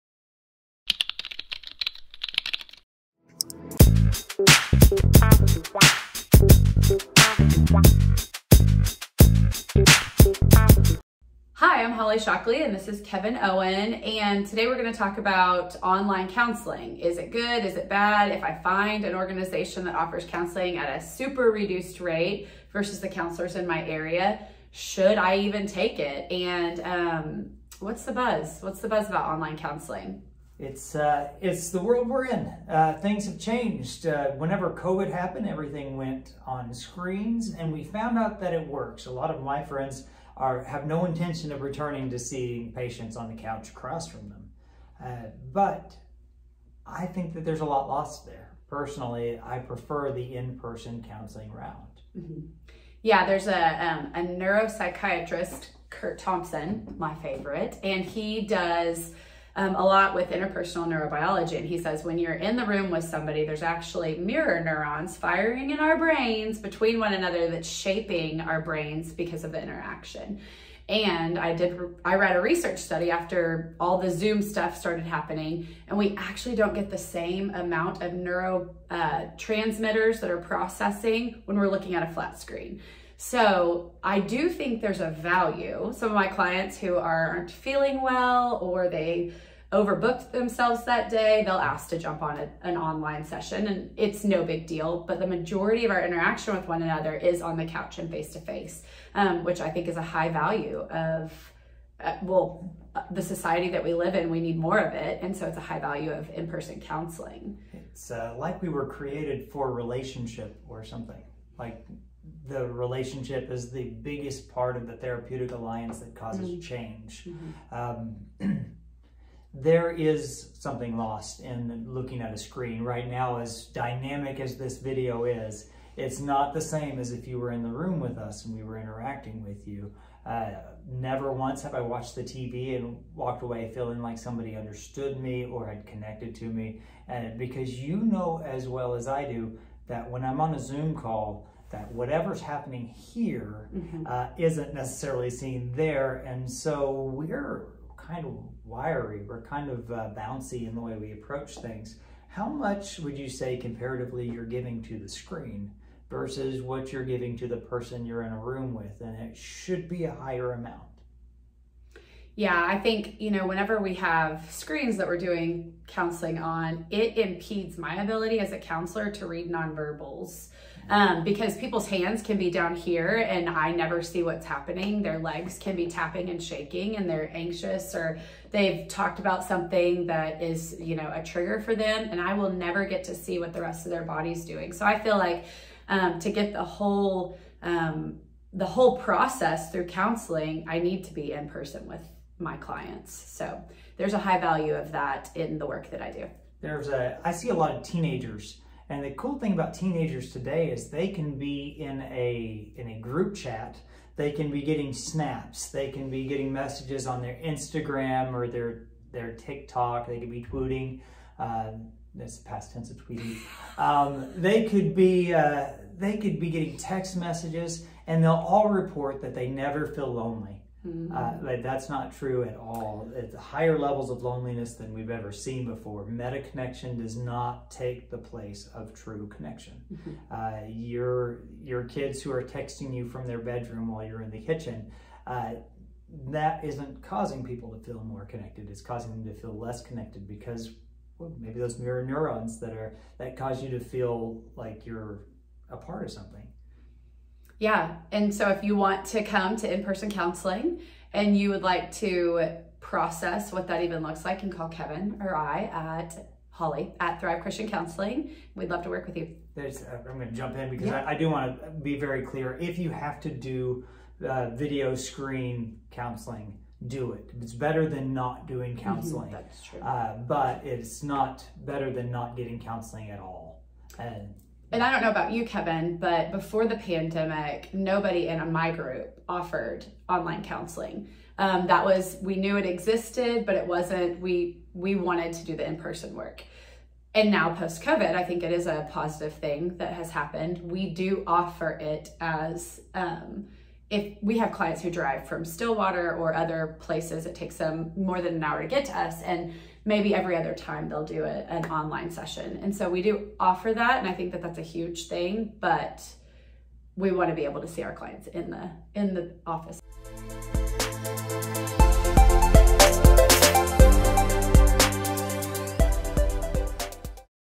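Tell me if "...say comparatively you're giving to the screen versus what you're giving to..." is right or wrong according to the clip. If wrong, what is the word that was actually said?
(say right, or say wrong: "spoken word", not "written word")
right.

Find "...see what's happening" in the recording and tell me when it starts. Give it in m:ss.
2:54.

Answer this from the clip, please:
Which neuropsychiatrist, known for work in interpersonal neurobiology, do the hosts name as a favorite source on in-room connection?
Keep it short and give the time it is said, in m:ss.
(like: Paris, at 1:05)
Curt Thompson, at 0:55.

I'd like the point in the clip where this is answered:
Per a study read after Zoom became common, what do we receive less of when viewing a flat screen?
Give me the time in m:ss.
1:18.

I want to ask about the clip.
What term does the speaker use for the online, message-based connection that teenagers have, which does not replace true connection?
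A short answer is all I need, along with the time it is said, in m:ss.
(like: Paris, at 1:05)
Meta connection, at 3:46.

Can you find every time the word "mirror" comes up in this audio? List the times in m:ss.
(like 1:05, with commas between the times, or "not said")
1:04, 4:01.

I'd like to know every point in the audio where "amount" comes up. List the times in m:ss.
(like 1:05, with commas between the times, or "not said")
1:17, 2:40.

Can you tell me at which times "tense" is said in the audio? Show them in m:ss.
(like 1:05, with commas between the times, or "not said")
3:32.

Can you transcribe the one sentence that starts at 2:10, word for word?
Uh, never once have I watched the TV and walked away feeling like somebody understood me or had connected to me.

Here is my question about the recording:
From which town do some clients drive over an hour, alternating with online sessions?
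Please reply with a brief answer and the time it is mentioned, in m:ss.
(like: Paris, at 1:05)
Stillwater, at 4:55.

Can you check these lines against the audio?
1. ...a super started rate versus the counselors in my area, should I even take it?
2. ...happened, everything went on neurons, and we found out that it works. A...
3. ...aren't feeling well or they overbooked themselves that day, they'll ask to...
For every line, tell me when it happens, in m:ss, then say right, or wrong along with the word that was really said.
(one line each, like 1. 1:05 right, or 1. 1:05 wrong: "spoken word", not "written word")
1. 0:21 wrong: "reduced", not "started"
2. 0:35 wrong: "screens", not "neurons"
3. 1:26 right.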